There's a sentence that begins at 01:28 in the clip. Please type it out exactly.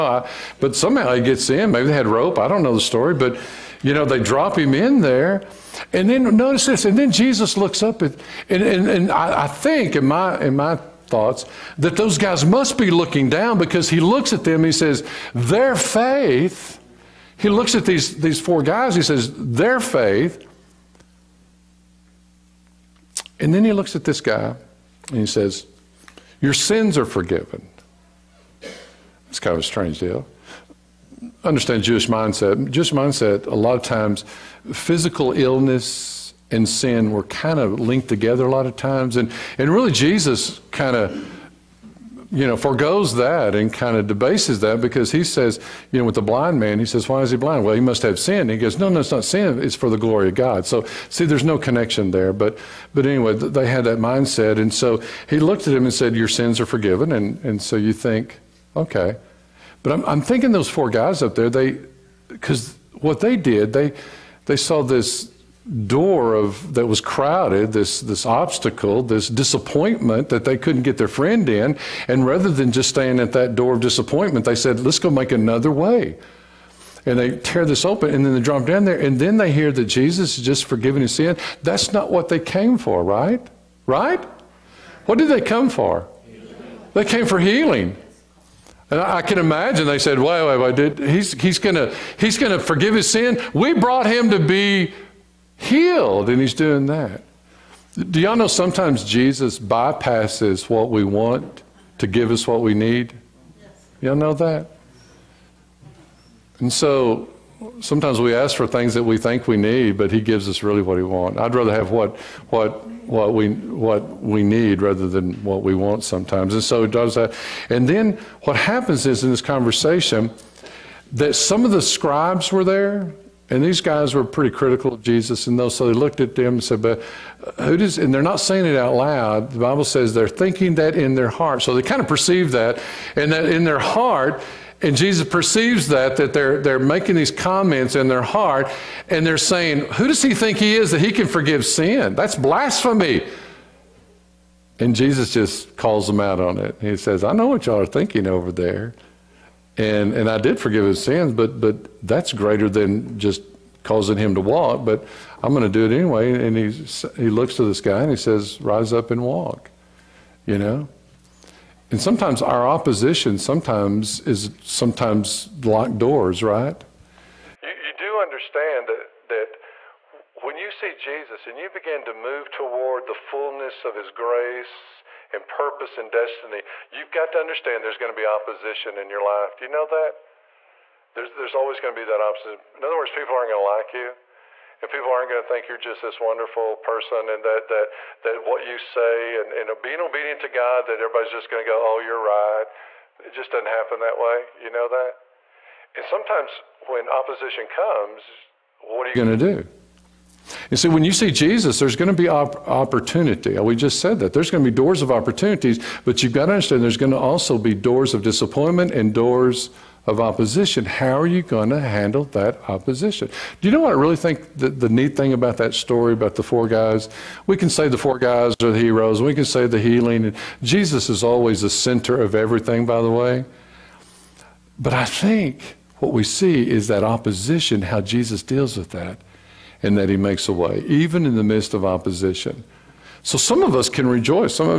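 And I can imagine they said, "Wait, wait, wait!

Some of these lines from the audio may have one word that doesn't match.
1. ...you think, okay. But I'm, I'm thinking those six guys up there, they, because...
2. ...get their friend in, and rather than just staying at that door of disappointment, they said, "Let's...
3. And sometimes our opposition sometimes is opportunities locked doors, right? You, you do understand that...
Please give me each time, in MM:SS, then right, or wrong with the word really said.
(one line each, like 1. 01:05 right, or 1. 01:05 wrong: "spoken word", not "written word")
1. 00:57 wrong: "four", not "six"
2. 01:10 right
3. 02:41 wrong: "sometimes", not "opportunities".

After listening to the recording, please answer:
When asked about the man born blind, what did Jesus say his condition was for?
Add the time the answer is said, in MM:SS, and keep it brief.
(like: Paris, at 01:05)
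The glory of God, at 00:49.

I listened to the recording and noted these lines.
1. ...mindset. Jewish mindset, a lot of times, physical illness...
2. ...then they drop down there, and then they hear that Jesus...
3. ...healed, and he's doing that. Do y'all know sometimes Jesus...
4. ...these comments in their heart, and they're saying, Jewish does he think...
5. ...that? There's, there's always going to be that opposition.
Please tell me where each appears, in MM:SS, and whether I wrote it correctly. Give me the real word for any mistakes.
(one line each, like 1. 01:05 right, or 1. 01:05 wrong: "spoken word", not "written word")
1. 00:32 right
2. 01:18 right
3. 01:35 right
4. 02:17 wrong: "Who", not "Jewish"
5. 02:59 right.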